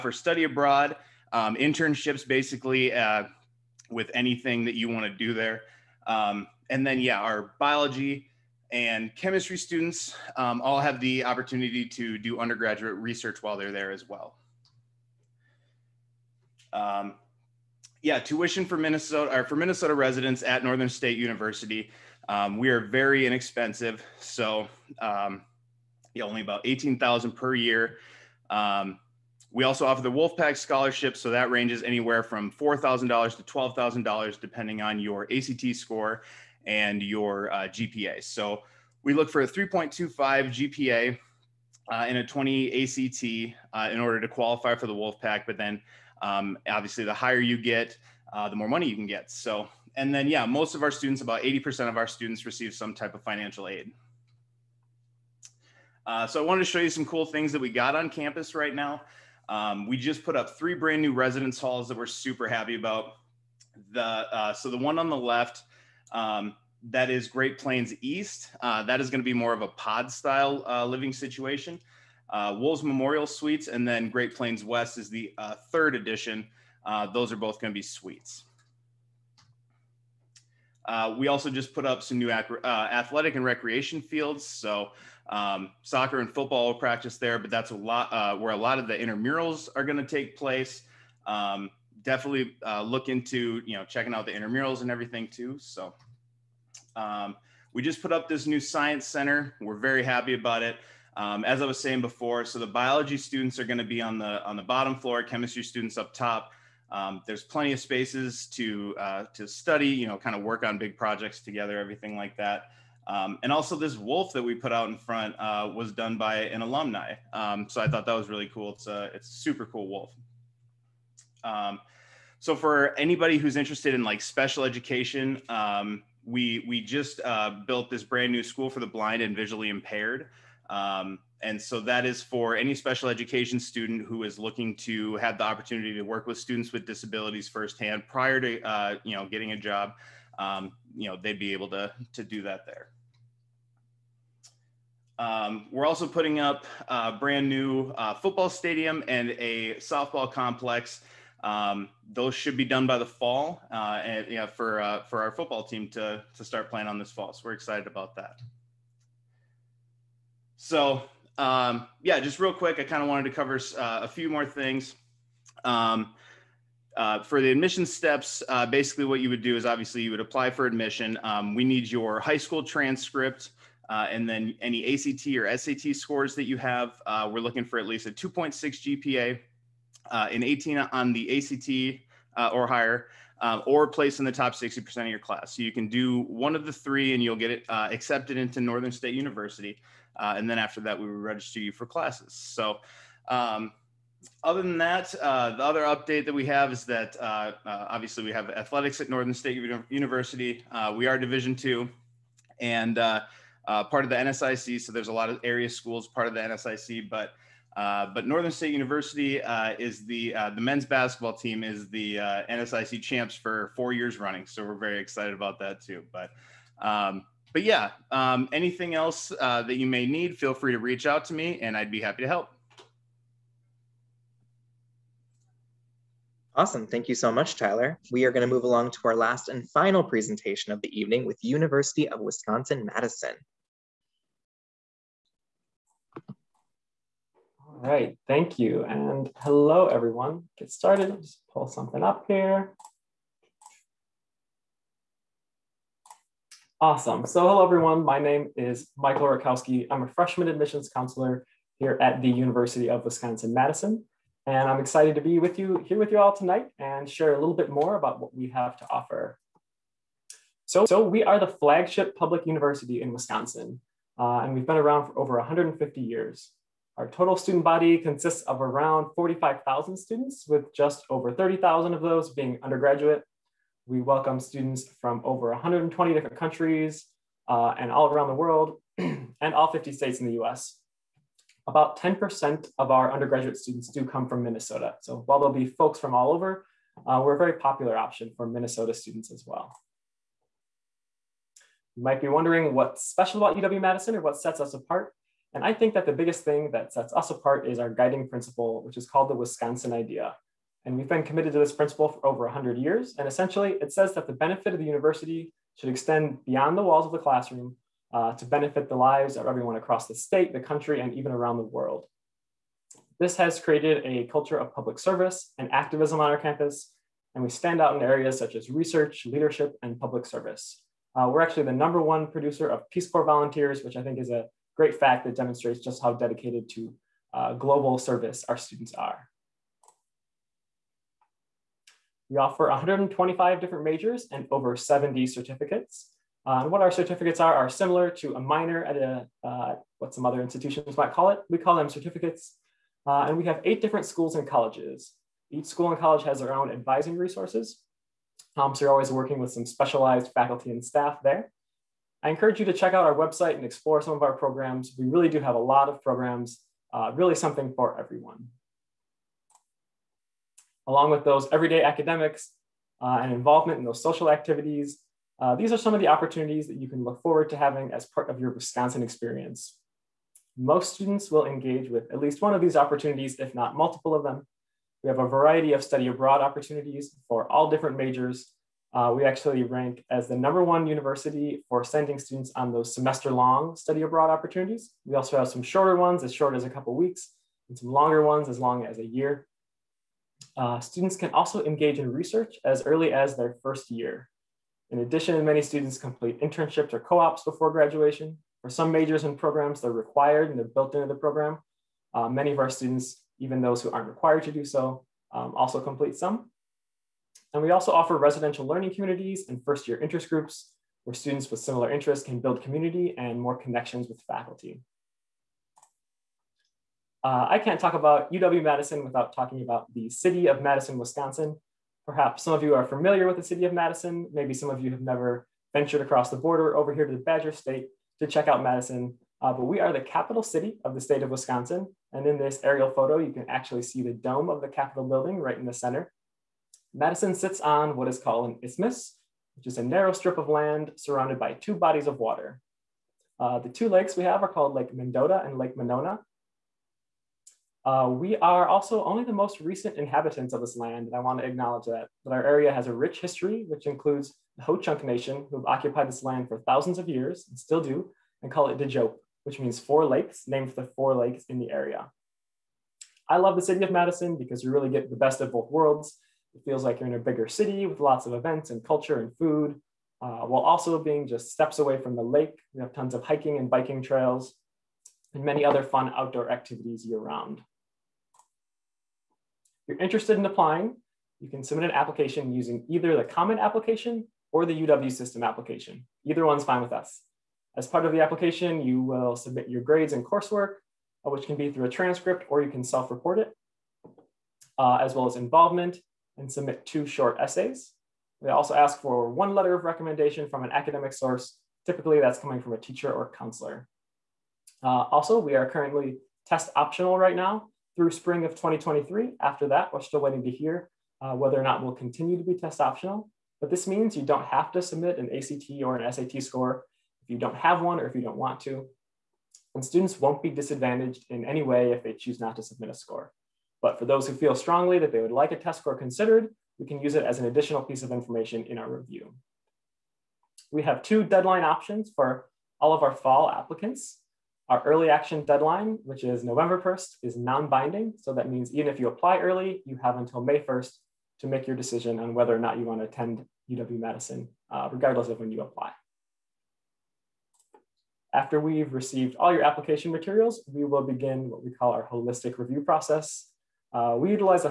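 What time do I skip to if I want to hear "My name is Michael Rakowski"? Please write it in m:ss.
4:08.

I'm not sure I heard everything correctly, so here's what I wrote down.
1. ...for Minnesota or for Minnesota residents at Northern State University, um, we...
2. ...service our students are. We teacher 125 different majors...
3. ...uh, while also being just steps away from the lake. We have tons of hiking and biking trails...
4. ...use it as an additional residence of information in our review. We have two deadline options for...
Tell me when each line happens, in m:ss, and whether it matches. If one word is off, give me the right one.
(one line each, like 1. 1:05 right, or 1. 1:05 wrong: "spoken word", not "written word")
1. 0:18 right
2. 5:27 wrong: "offer", not "teacher"
3. 7:50 right
4. 8:47 wrong: "piece", not "residence".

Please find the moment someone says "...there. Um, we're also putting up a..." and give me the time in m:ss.
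2:22.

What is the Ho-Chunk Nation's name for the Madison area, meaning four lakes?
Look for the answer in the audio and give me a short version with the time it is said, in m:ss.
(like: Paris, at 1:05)
Dejope, at 7:38.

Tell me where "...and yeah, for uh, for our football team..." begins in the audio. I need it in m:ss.
2:34.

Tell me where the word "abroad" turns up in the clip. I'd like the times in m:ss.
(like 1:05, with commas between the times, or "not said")
0:00, 6:16, 6:24.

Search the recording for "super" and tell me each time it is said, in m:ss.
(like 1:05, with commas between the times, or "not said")
1:02, 1:59.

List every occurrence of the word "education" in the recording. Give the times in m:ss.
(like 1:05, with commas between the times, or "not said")
2:04, 2:13.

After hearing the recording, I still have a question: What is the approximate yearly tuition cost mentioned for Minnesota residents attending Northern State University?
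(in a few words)
$18,000.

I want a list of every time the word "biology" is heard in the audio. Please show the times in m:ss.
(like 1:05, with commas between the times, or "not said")
0:07, 1:42.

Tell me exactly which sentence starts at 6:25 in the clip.
We also have some shorter ones as short as a couple weeks and some longer ones as long as a year.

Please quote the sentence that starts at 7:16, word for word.
Madison sits on what is called an isthmus, which is a narrow strip of land surrounded by two bodies of water.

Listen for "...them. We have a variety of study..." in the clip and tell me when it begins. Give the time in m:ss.
6:14.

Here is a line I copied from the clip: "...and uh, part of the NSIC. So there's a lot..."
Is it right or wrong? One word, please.
right.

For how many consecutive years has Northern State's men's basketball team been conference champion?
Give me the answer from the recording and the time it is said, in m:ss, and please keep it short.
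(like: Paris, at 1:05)
4, at 3:33.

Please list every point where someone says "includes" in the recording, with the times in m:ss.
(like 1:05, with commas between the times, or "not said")
7:33.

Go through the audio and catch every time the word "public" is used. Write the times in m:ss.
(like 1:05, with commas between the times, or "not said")
4:22, 5:14, 5:19.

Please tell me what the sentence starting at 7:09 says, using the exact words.
Uh, but we are the capital city of the state of Wisconsin.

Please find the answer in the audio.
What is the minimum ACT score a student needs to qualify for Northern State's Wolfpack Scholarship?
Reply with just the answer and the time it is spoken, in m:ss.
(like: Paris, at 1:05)
20, at 0:42.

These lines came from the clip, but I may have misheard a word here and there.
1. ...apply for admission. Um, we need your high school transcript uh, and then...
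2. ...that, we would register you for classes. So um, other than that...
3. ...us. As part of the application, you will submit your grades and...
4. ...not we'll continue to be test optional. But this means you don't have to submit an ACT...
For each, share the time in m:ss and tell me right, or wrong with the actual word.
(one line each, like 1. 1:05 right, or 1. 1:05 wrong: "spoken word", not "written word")
1. 2:50 right
2. 3:10 right
3. 8:06 right
4. 8:31 right.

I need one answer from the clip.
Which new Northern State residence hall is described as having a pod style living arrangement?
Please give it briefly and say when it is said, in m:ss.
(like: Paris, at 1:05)
Great Plains East, at 1:07.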